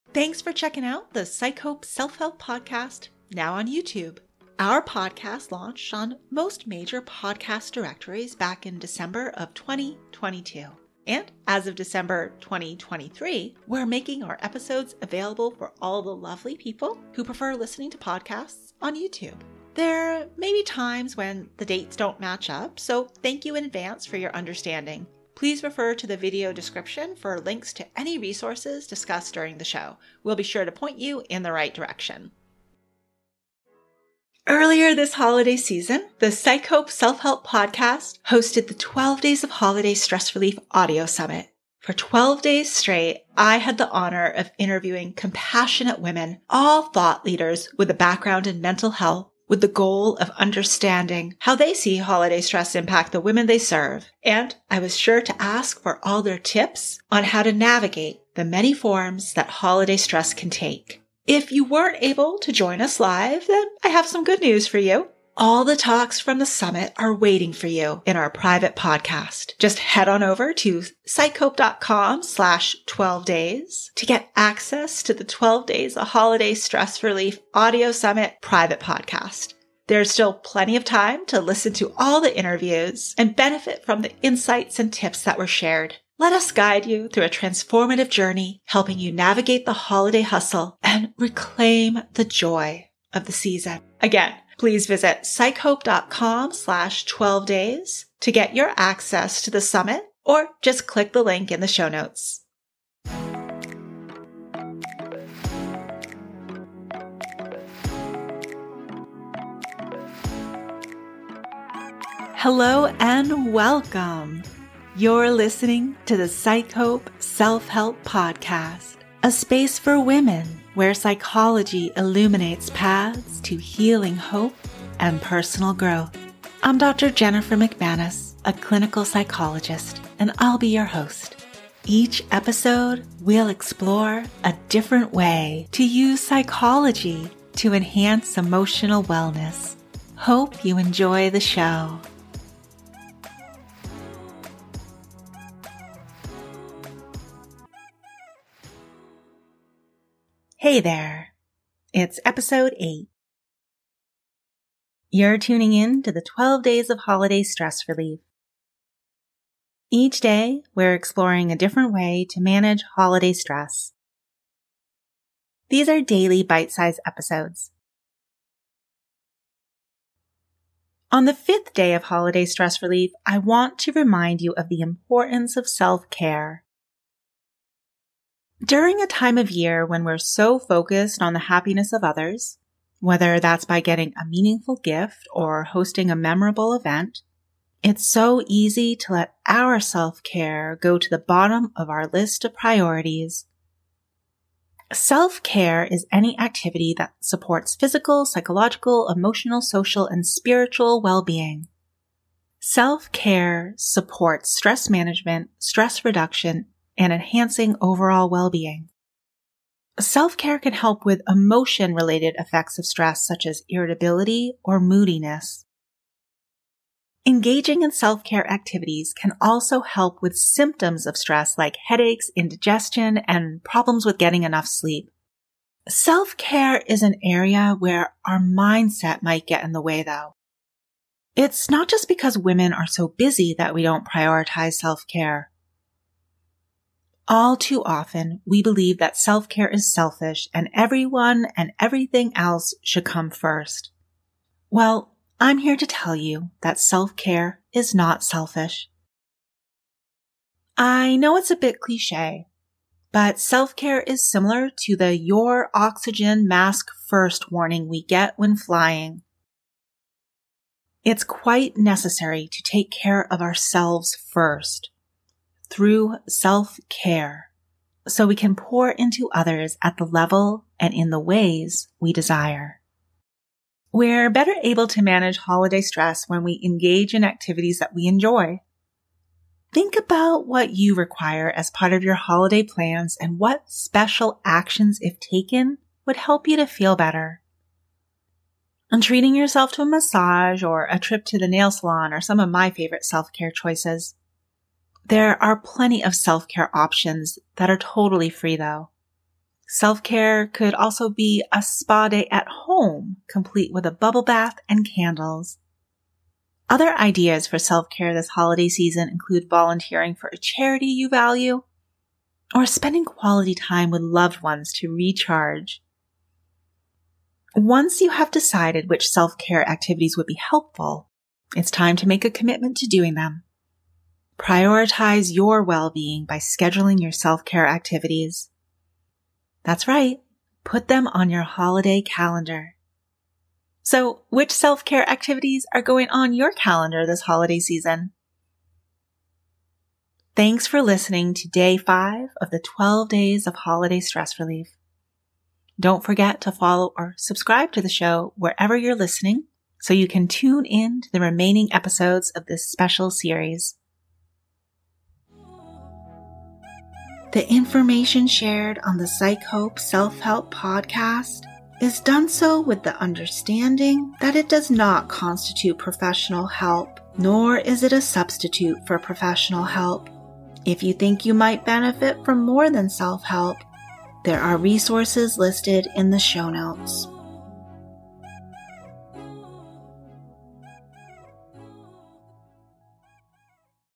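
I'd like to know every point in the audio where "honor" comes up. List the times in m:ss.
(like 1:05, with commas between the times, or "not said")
0:43.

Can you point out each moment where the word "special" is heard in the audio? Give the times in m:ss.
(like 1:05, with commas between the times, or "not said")
4:43, 5:52.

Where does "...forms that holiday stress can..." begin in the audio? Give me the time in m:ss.
0:58.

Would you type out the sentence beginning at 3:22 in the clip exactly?
Self care supports stress management, stress reduction, and enhancing overall well-being.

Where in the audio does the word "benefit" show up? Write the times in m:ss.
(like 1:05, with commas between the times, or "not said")
1:23, 6:11.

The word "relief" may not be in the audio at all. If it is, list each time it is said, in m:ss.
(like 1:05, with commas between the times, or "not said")
0:40, 1:17, 2:37, 2:52, 5:44.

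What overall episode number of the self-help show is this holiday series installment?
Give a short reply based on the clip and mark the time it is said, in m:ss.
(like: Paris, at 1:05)
8, at 2:32.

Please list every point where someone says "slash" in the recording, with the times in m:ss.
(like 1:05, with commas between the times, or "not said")
1:12, 1:36.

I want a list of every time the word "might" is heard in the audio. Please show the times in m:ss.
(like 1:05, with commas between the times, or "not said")
3:49, 6:11.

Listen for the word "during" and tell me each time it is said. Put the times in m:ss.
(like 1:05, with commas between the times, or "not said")
0:29, 2:58.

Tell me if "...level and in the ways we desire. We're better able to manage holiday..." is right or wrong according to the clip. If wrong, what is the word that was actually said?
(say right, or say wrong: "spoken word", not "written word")
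right.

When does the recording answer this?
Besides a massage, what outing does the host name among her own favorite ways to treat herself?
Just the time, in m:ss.
4:51.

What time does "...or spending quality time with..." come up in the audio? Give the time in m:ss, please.
5:12.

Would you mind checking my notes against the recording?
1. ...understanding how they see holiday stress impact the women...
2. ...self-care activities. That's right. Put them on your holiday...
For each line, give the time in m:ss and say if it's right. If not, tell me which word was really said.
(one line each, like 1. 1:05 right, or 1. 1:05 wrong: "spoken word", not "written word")
1. 0:50 right
2. 5:27 right.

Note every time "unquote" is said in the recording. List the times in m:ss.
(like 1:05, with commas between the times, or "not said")
not said.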